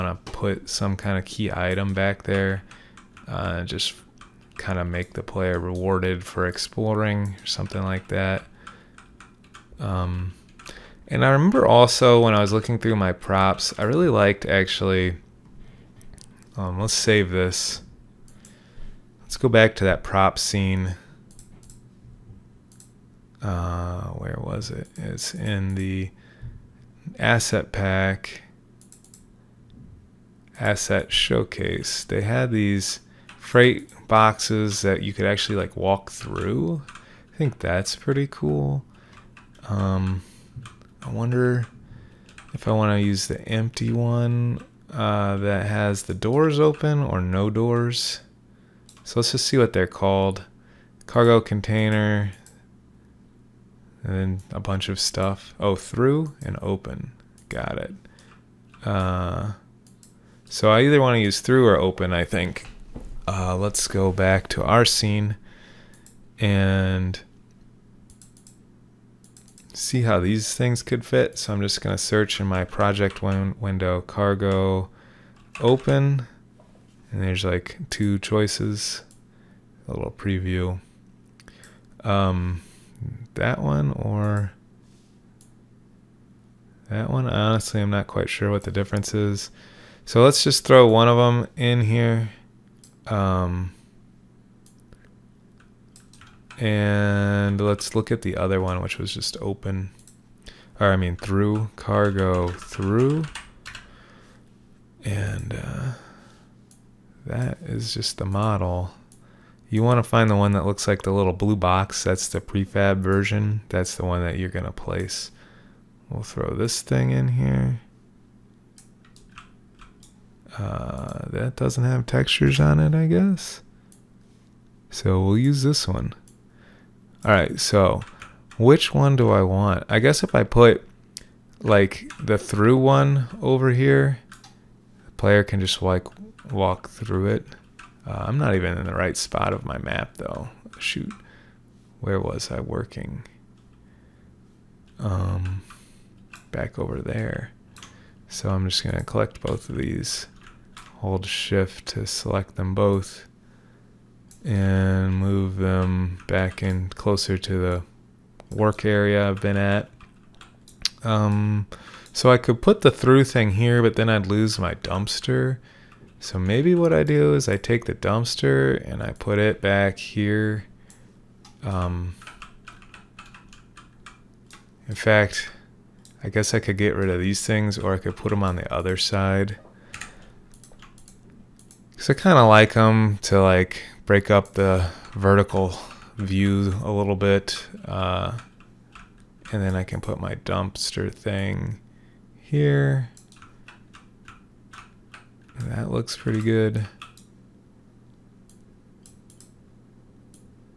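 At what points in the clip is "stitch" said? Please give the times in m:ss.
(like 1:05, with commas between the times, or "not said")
not said.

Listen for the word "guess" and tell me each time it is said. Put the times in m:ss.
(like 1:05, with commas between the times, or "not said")
2:03, 2:09, 2:56.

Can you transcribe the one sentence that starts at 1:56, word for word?
We'll throw this thing in here.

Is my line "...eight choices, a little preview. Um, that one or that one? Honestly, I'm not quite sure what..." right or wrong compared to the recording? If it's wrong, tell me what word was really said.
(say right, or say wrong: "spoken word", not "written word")
wrong: "two", not "eight".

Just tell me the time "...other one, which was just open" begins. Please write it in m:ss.
1:38.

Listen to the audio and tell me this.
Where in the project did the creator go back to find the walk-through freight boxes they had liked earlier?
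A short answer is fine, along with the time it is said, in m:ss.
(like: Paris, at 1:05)
asset showcase, at 0:30.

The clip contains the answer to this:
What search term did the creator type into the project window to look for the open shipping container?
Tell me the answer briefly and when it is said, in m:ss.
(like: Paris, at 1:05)
cargo open, at 1:14.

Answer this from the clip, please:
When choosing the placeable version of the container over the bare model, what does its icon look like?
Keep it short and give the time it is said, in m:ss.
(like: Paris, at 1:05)
little blue box, at 1:51.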